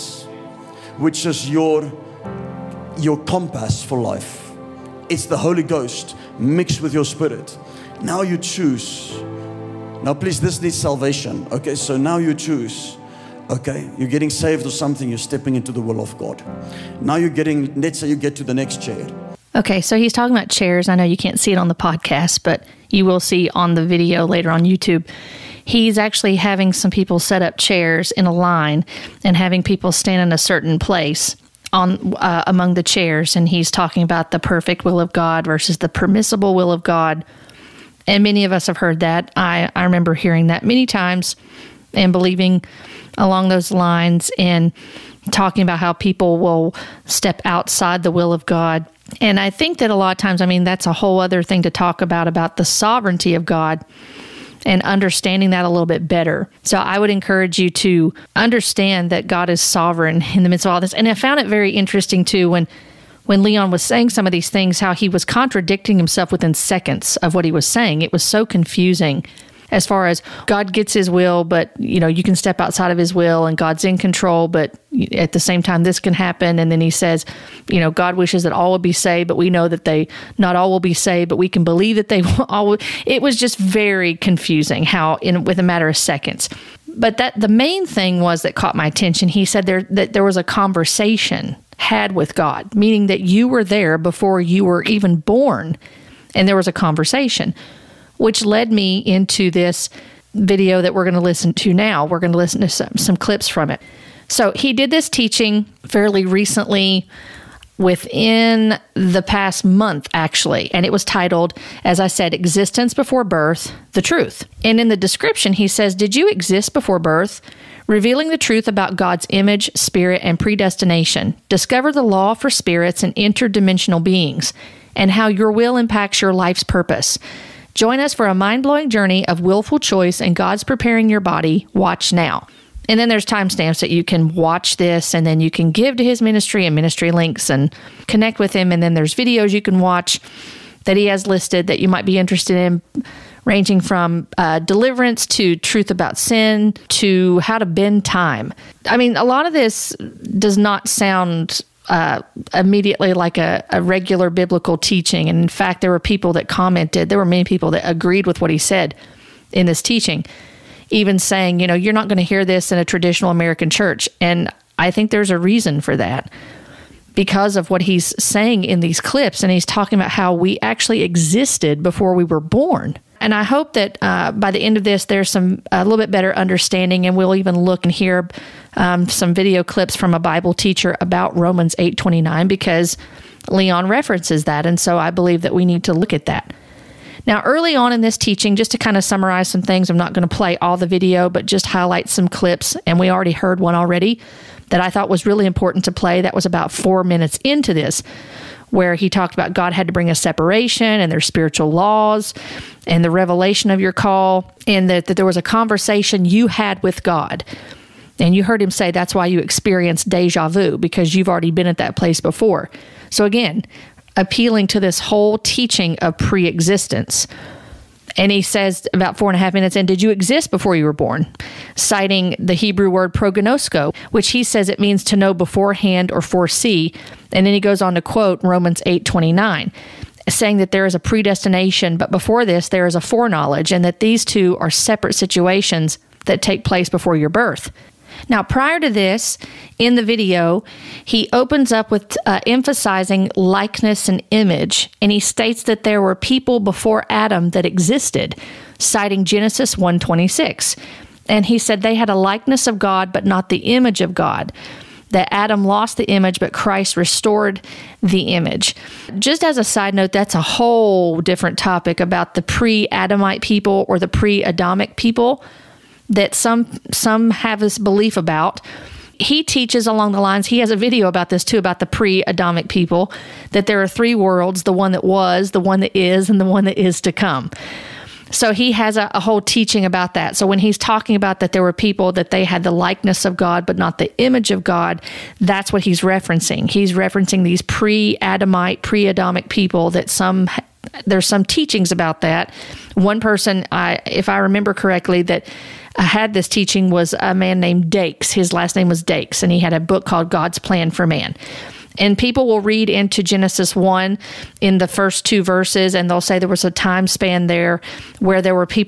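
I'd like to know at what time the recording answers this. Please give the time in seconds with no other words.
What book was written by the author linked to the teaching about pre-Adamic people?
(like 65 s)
300 s.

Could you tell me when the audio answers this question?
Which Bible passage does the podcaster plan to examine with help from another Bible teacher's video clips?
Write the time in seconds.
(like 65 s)
181 s.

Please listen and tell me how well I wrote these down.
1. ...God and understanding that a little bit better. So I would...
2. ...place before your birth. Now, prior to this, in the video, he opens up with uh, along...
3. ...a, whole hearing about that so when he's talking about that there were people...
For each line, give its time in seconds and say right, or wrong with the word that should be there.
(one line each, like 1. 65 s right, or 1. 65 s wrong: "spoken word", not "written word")
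1. 53 s right
2. 236 s wrong: "emphasizing", not "along"
3. 279 s wrong: "teaching", not "hearing".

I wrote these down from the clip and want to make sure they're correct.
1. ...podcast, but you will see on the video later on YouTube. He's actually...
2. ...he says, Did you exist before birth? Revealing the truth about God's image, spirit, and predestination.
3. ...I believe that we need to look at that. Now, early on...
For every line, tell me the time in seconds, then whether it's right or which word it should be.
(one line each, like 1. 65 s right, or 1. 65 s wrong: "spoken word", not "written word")
1. 21 s right
2. 115 s right
3. 184 s right.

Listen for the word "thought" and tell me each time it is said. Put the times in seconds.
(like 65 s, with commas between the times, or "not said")
194 s.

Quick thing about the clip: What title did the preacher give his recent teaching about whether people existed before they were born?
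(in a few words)
Existence Before Birth The Truth.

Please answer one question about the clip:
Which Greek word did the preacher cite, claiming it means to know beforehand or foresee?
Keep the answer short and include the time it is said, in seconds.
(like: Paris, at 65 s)
prognosko, at 223 s.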